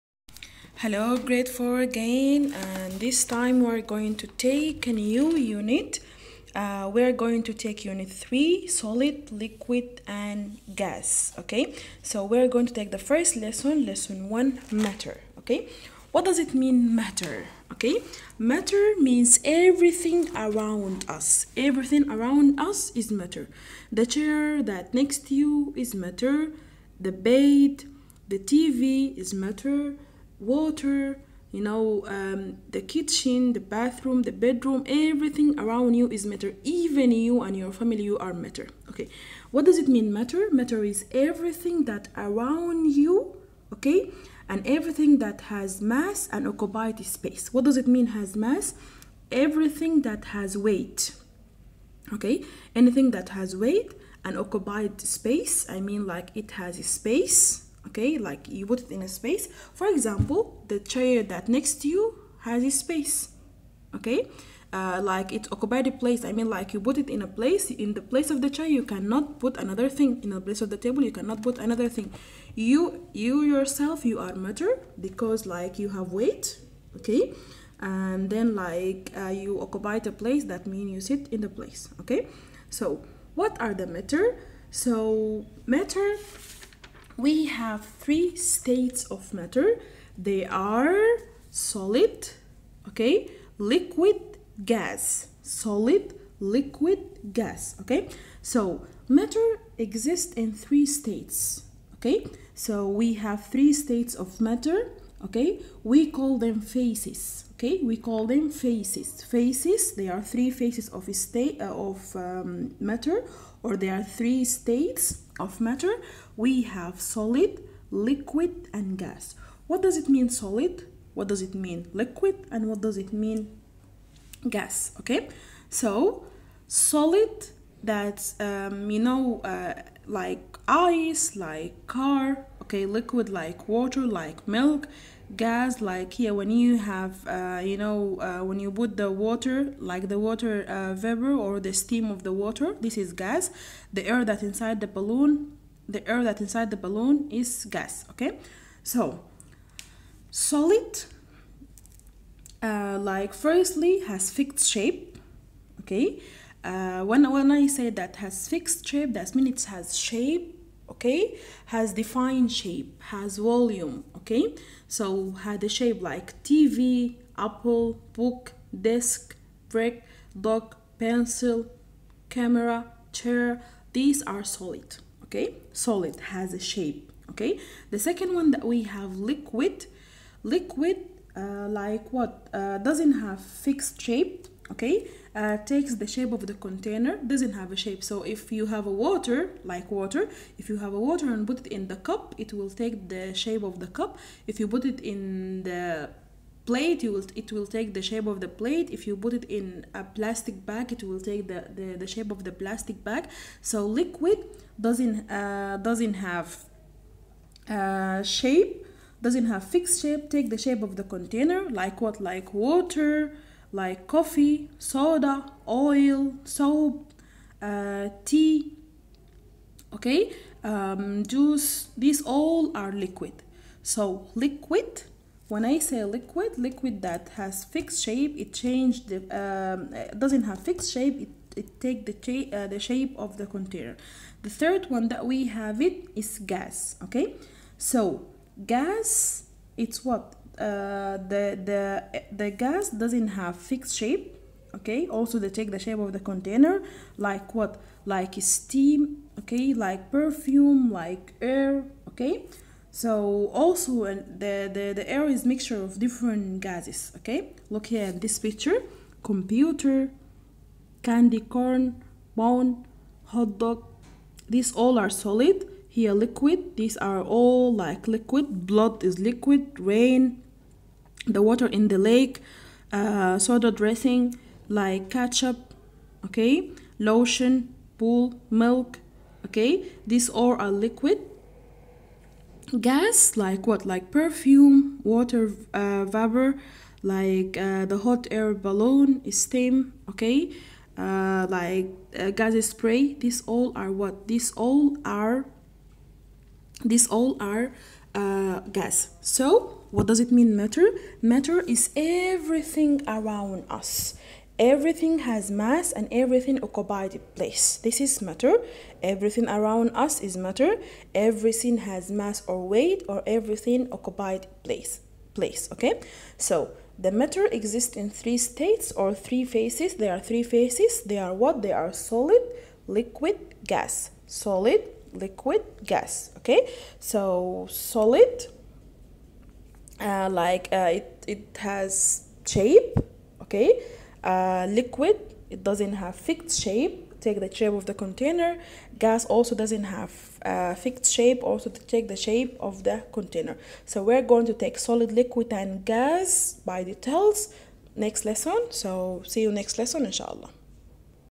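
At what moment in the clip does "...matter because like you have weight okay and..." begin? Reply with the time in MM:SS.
01:14.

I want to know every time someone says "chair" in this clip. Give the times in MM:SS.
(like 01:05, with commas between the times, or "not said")
00:24, 01:00, 01:08, 02:53.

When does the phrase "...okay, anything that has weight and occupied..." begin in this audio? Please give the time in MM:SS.
00:52.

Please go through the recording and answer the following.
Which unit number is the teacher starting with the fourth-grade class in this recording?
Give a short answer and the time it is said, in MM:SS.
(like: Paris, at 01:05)
3, at 00:07.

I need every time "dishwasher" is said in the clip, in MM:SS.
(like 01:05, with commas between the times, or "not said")
not said.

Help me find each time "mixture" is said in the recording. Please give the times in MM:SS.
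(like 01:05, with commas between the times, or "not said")
04:15.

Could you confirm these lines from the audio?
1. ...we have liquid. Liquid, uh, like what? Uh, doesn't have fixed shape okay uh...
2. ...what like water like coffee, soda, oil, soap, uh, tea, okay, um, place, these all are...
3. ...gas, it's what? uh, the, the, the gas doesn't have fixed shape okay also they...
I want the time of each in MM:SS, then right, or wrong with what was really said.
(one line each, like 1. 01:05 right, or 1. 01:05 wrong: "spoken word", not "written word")
1. 02:58 right
2. 03:32 wrong: "juice", not "place"
3. 03:58 right.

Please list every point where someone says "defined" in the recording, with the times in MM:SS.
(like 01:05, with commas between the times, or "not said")
02:41.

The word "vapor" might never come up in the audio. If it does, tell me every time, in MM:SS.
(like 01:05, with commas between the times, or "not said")
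02:20, 04:46.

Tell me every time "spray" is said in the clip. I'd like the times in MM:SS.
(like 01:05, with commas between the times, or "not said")
04:52.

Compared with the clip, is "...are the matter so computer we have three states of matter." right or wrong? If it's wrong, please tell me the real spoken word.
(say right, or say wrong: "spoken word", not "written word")
wrong: "matter", not "computer".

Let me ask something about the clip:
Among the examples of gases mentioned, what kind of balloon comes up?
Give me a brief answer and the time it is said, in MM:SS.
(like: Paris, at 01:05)
hot air balloon, at 04:48.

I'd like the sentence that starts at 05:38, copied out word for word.
Gas also doesn't have uh, fixed shape.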